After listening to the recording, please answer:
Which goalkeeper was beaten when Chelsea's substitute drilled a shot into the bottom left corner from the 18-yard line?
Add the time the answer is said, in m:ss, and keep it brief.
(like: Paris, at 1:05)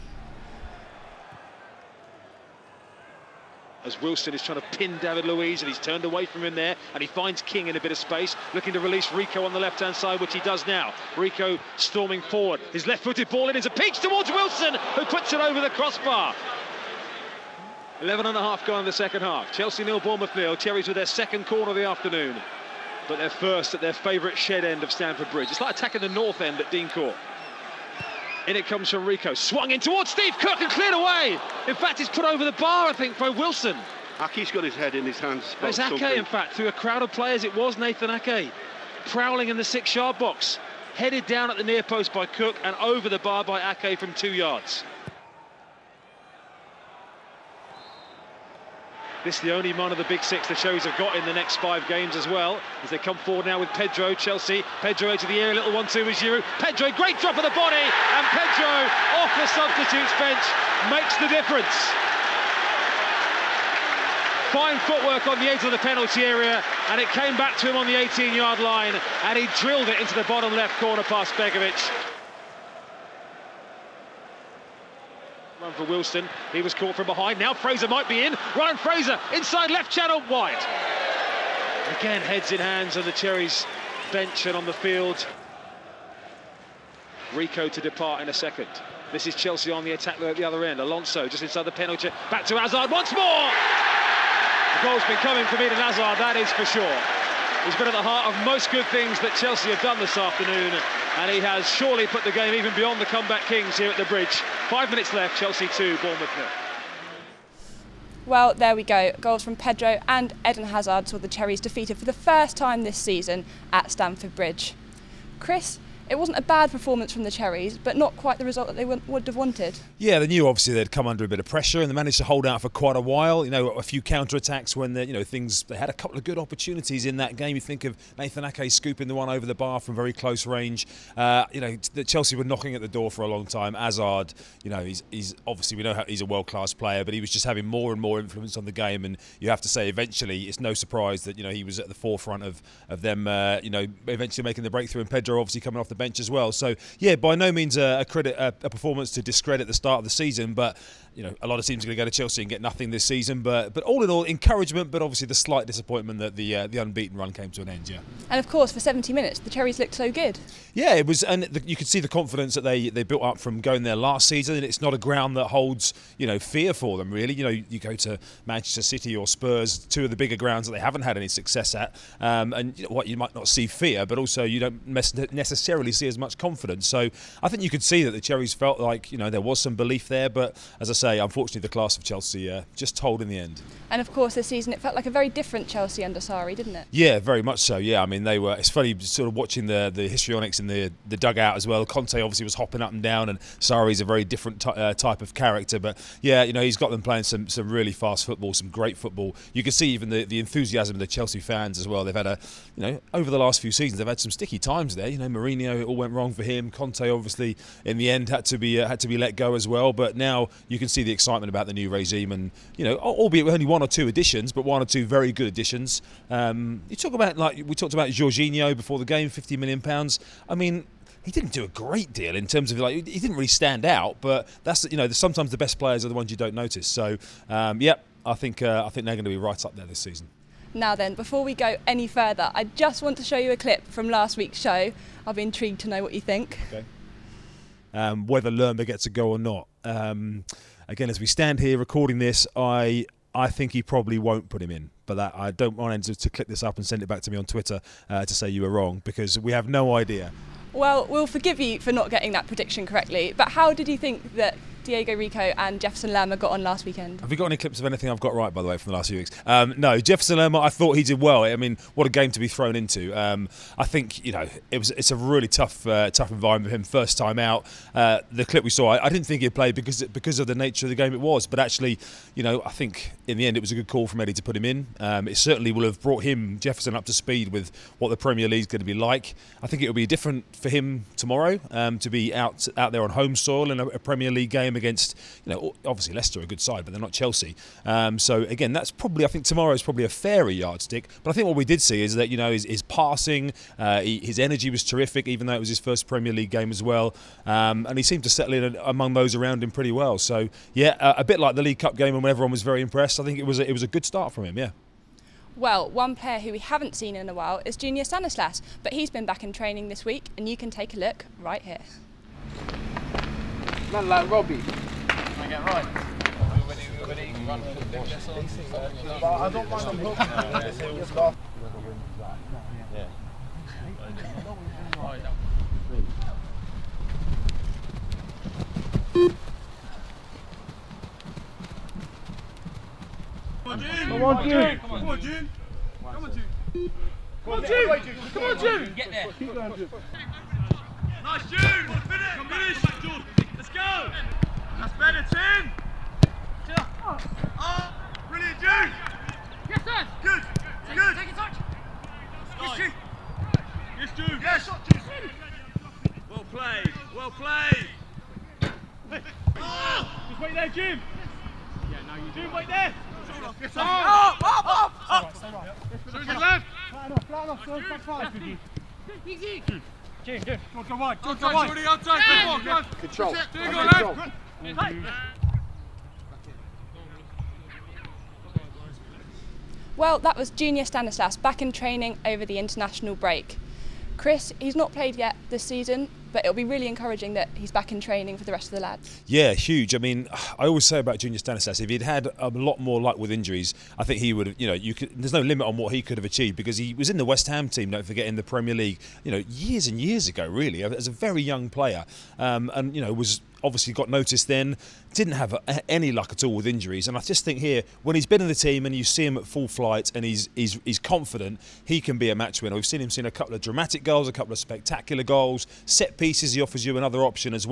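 Begovic, at 1:11.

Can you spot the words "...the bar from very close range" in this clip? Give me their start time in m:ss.
2:09.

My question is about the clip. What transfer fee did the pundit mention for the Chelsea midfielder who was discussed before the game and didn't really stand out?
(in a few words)
£50 million.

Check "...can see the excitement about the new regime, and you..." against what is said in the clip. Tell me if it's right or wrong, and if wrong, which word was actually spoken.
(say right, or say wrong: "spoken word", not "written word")
right.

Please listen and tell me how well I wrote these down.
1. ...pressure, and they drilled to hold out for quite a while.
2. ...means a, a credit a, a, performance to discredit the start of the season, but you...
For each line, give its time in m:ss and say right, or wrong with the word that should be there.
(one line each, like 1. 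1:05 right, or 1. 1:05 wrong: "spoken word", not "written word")
1. 2:01 wrong: "managed", not "drilled"
2. 2:27 right.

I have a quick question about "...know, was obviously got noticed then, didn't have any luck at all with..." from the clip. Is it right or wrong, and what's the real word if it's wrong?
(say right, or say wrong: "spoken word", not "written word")
right.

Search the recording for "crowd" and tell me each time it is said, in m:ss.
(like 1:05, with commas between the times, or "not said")
0:36.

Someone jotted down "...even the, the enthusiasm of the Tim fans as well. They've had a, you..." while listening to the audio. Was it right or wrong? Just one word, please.
wrong.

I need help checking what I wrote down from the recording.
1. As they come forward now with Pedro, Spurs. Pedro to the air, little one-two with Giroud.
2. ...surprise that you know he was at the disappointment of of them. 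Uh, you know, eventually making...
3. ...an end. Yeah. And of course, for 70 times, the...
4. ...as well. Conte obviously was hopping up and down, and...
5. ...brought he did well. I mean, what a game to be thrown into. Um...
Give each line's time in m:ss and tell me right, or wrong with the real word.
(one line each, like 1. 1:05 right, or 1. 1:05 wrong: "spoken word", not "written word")
1. 0:52 wrong: "Chelsea", not "Spurs"
2. 2:20 wrong: "forefront", not "disappointment"
3. 2:37 wrong: "minutes", not "times"
4. 3:11 right
5. 4:20 wrong: "thought", not "brought".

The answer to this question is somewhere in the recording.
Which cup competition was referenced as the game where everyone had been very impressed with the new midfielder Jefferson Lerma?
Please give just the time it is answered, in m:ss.
5:01.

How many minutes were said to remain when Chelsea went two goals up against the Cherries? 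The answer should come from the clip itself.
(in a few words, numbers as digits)
5.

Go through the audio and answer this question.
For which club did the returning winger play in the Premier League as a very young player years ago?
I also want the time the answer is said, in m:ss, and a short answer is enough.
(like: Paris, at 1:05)
West Ham, at 6:37.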